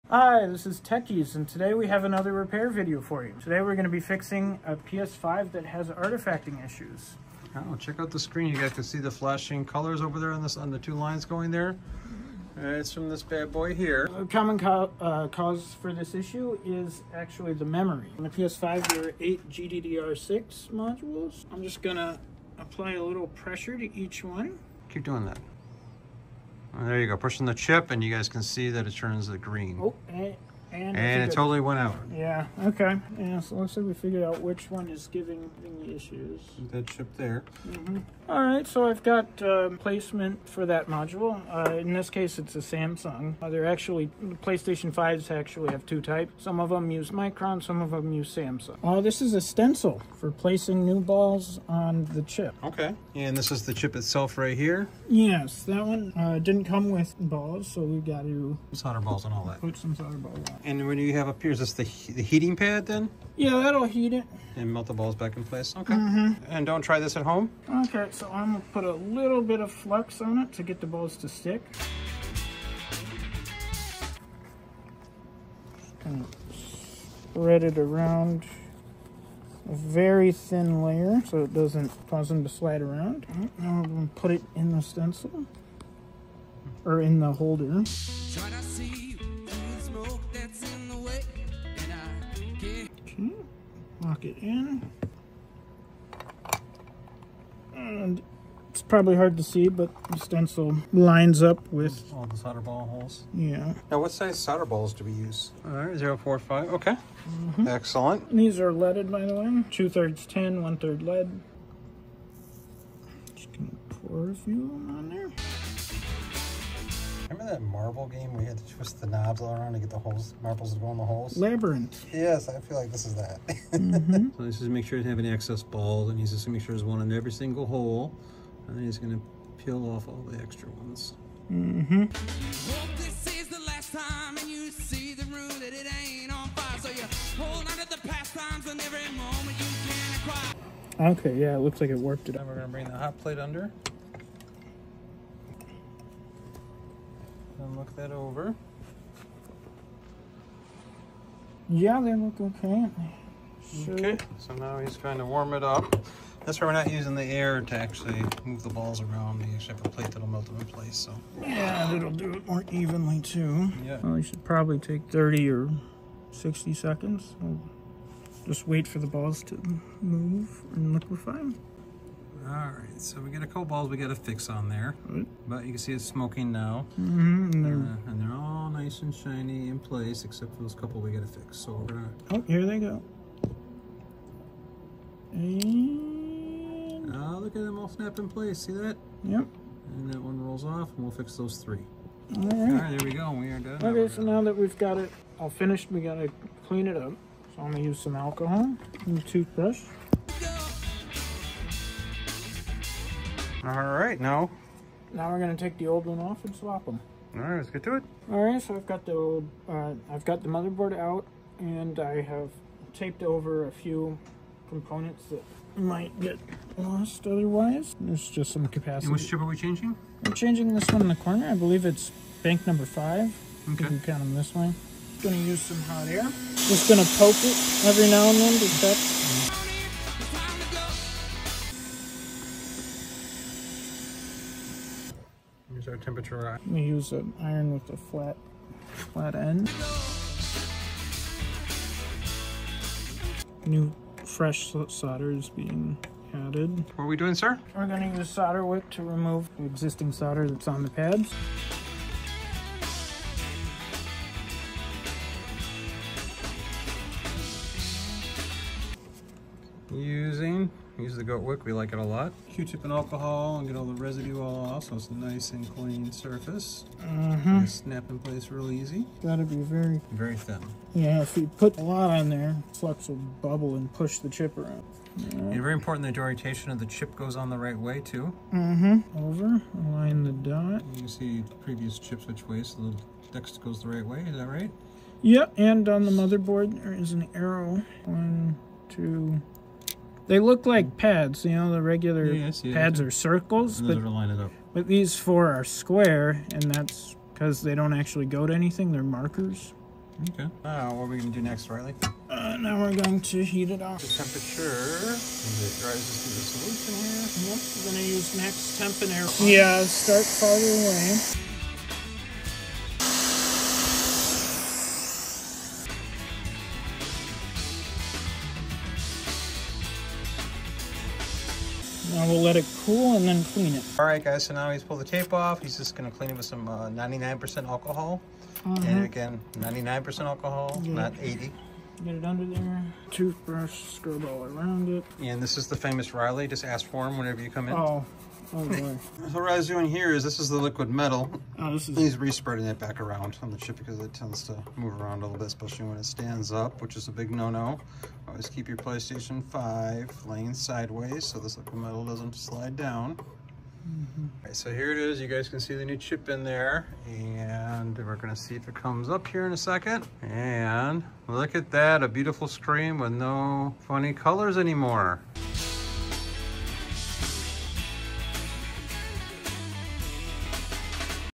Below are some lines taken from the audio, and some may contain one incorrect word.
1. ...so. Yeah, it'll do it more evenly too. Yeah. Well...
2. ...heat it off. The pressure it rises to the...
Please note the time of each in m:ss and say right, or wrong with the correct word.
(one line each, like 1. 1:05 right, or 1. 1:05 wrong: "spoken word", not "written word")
1. 2:40 right
2. 5:03 wrong: "temperature", not "pressure".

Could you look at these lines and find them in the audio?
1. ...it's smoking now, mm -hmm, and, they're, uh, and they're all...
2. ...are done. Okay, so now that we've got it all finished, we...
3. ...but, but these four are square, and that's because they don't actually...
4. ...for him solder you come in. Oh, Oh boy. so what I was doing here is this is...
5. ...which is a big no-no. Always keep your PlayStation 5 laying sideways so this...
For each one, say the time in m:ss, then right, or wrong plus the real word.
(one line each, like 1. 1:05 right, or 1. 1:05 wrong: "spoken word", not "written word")
1. 2:55 right
2. 3:13 right
3. 4:53 right
4. 5:36 wrong: "whenever", not "solder"
5. 5:46 right.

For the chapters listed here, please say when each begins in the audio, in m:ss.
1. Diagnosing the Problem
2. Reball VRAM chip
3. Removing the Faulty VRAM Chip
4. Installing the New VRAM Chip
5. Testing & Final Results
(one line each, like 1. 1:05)
1. 0:15
2. 0:39
3. 3:37
4. 4:37
5. 5:38.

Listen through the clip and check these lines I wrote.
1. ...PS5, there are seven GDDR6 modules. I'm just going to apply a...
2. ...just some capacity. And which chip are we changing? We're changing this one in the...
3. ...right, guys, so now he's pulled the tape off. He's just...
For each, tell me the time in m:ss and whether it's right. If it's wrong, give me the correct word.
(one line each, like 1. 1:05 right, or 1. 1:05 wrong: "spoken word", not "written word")
1. 0:18 wrong: "eight", not "seven"
2. 3:38 right
3. 5:24 right.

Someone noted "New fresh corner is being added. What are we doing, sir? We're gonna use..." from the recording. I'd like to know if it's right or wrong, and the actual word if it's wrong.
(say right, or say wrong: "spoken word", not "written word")
wrong: "solder", not "corner".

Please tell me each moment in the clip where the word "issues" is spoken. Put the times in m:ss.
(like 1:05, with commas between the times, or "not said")
0:06, 0:16, 0:35.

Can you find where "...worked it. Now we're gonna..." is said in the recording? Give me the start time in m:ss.
2:21.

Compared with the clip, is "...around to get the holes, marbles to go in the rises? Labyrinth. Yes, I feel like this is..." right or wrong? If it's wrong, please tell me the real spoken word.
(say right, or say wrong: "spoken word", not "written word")
wrong: "holes", not "rises".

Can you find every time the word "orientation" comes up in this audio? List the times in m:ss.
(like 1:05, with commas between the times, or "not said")
4:36.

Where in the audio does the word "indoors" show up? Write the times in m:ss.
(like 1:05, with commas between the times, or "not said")
not said.